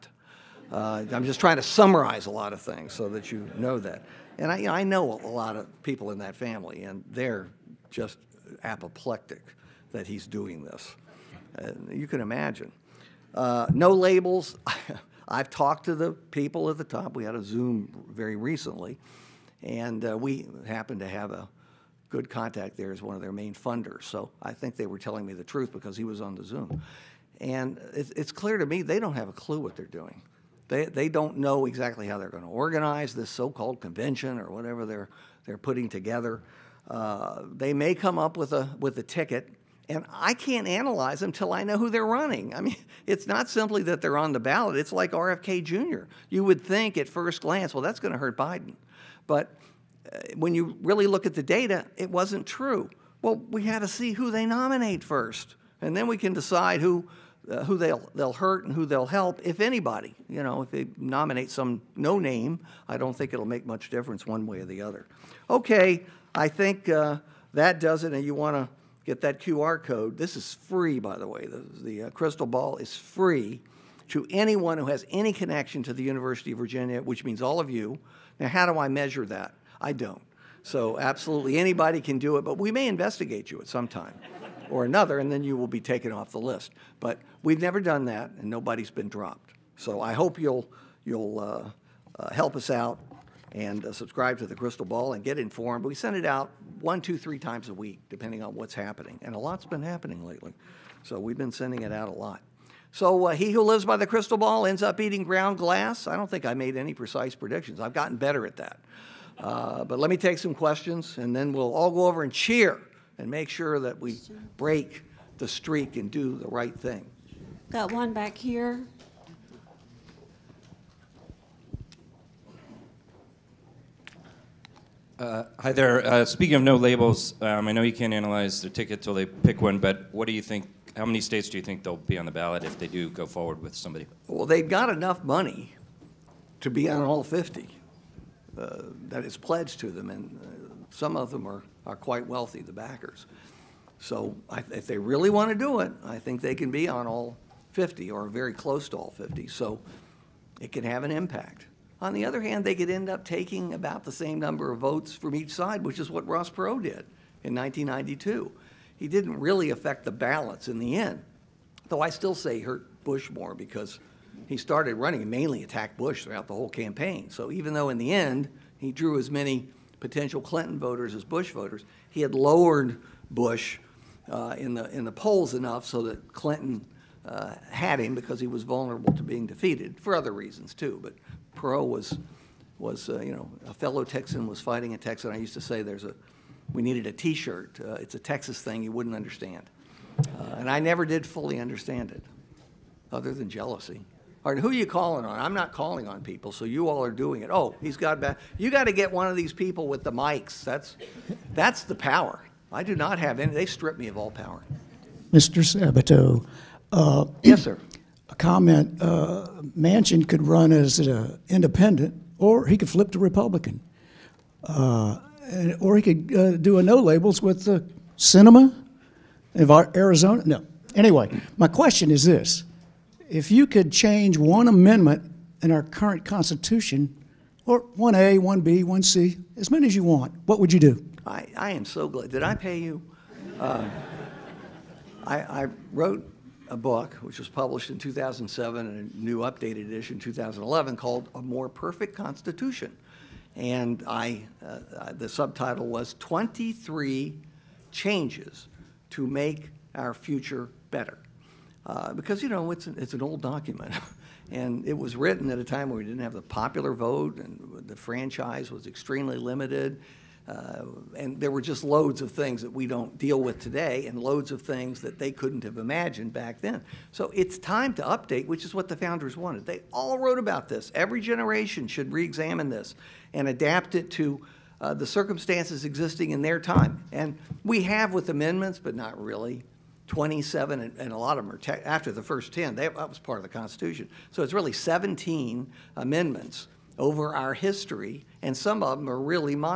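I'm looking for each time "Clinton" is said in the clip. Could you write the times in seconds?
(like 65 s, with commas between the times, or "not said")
170 s, 176 s.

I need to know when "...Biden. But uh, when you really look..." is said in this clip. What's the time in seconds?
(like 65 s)
48 s.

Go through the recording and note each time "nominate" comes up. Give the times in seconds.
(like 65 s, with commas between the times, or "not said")
54 s, 60 s.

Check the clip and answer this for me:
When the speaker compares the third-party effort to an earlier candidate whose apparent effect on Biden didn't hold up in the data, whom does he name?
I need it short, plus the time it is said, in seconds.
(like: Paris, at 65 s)
RFK Jr., at 45 s.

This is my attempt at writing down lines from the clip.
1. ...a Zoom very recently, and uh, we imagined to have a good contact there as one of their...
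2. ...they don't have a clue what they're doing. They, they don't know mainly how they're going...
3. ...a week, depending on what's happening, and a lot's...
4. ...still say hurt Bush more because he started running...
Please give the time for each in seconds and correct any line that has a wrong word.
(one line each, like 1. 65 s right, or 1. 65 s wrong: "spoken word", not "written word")
1. 17 s wrong: "happened", not "imagined"
2. 28 s wrong: "exactly", not "mainly"
3. 97 s right
4. 162 s right.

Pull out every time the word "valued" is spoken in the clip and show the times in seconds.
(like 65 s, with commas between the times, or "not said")
not said.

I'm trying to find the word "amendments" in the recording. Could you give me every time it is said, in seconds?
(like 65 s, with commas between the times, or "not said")
224 s, 278 s, 285 s.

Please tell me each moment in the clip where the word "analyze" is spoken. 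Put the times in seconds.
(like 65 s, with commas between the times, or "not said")
40 s, 128 s.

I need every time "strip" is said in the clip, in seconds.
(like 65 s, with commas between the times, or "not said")
203 s.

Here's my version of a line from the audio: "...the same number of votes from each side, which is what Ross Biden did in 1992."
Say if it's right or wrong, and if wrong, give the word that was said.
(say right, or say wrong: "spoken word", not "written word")
wrong: "Perot", not "Biden".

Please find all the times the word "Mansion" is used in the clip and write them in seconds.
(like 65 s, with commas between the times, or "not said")
209 s.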